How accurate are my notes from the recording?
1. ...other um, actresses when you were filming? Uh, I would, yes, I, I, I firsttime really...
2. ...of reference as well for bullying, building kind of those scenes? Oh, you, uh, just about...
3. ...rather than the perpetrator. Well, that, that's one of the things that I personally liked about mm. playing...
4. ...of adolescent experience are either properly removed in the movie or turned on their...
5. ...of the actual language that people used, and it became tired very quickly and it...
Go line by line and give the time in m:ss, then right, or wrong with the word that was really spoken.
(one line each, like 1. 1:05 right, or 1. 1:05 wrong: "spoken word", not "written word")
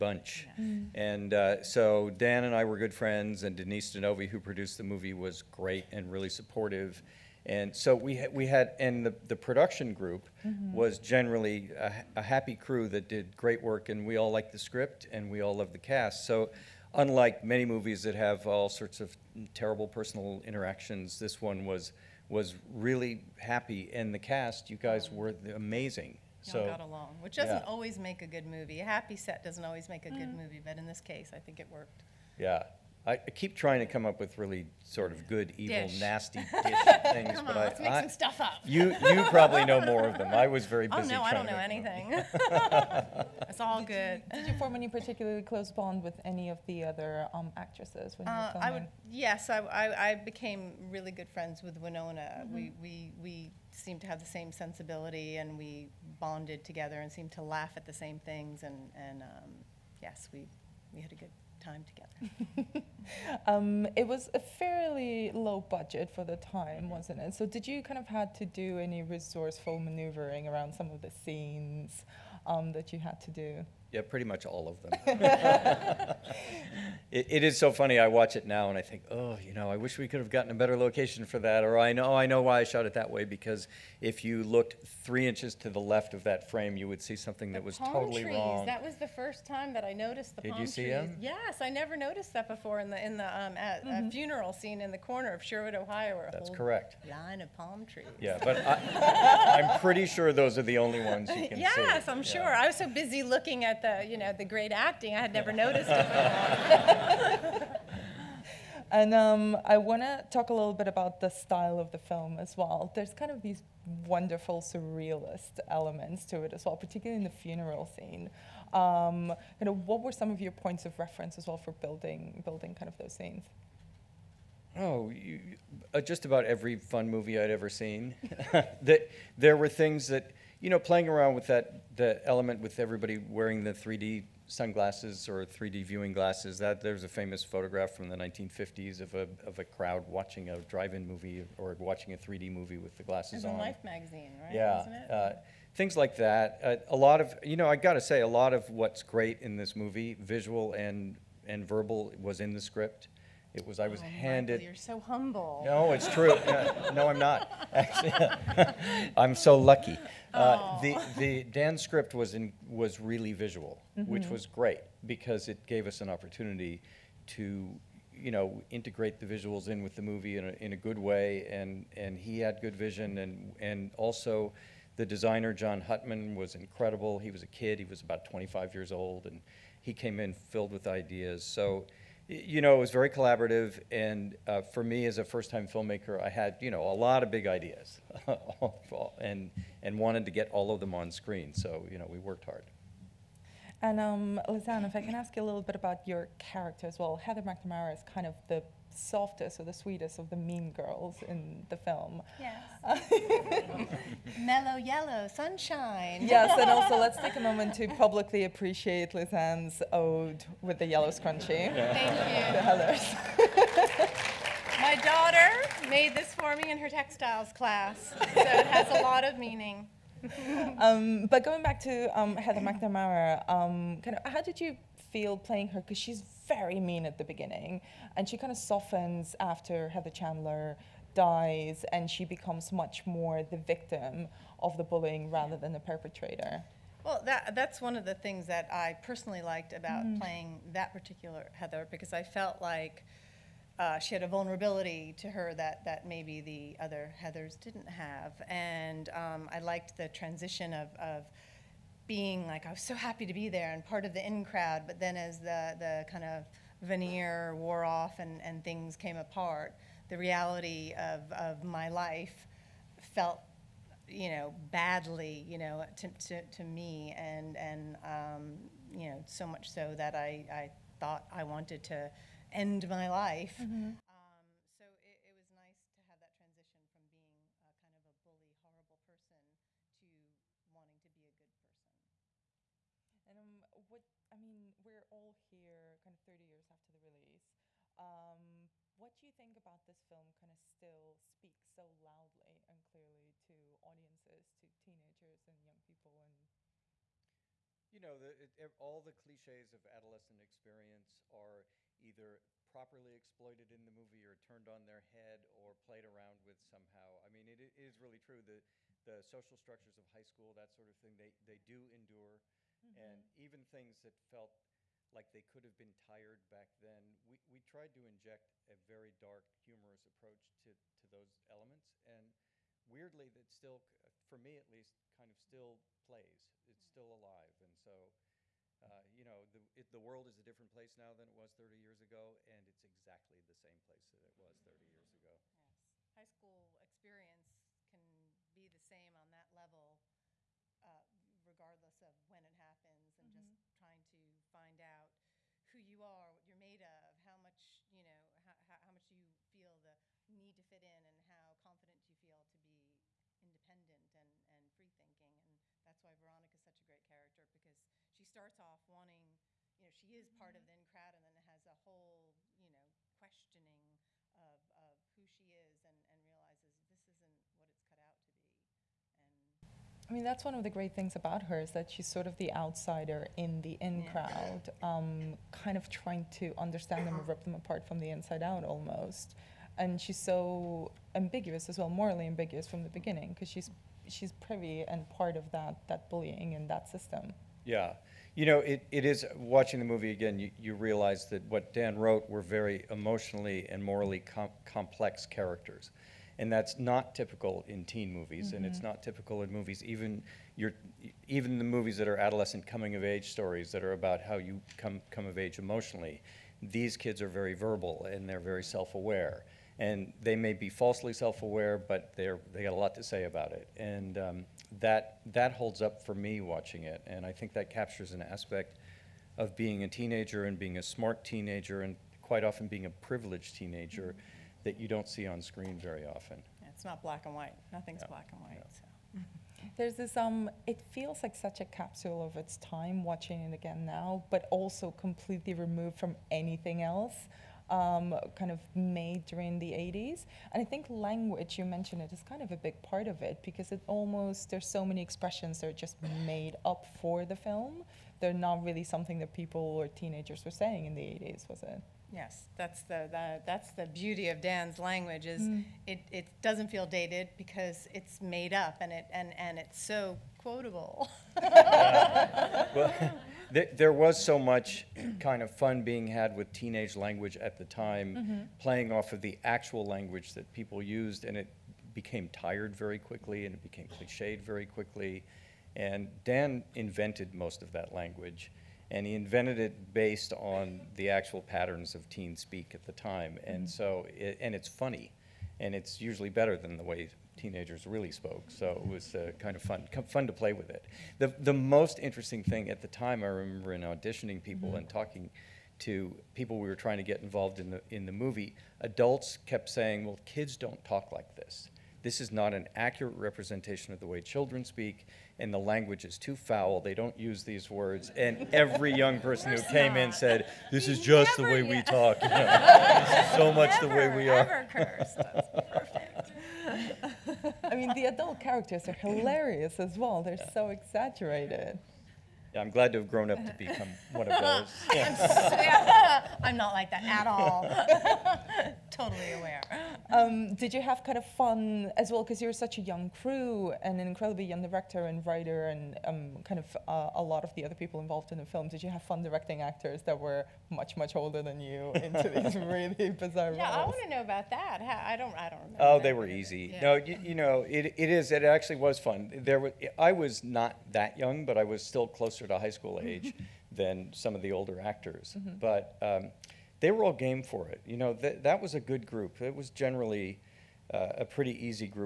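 1. 0:46 wrong: "became", not "firsttime"
2. 2:00 wrong: "building", not "bullying"
3. 3:55 right
4. 4:59 wrong: "exploited", not "removed"
5. 7:49 right.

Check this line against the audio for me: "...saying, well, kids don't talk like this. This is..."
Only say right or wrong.
right.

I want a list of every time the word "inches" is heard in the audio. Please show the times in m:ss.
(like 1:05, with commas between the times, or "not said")
1:25.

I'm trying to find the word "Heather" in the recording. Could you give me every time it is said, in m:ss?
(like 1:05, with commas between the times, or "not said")
3:17, 3:42, 3:49, 4:01, 4:07.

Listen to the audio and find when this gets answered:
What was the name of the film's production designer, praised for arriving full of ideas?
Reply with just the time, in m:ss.
2:55.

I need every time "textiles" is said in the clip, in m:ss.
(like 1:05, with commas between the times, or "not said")
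3:36.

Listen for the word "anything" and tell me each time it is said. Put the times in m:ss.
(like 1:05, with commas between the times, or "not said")
0:41, 7:16.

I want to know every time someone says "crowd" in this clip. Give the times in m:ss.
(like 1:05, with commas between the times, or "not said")
2:19, 4:14, 6:00, 6:14.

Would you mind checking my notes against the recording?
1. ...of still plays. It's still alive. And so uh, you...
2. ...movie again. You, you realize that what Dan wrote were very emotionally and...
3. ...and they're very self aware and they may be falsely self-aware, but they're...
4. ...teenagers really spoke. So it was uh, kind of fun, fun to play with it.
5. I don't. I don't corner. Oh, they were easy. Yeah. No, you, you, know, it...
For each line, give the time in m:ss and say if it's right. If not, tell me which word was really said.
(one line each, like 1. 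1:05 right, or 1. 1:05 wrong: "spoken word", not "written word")
1. 5:25 right
2. 6:29 right
3. 6:48 right
4. 8:07 right
5. 9:05 wrong: "remember", not "corner".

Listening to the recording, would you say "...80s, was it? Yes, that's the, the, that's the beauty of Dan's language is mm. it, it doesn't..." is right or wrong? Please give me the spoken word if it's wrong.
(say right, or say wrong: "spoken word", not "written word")
right.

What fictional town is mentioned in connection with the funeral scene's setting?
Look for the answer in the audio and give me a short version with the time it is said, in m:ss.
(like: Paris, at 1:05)
Sherwood, Ohio, at 1:35.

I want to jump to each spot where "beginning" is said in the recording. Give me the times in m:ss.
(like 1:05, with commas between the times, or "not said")
3:47, 6:22.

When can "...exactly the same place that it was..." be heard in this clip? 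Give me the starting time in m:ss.
5:32.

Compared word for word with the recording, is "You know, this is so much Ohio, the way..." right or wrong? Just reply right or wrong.
wrong.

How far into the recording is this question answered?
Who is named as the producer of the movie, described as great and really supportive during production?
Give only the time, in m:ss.
0:03.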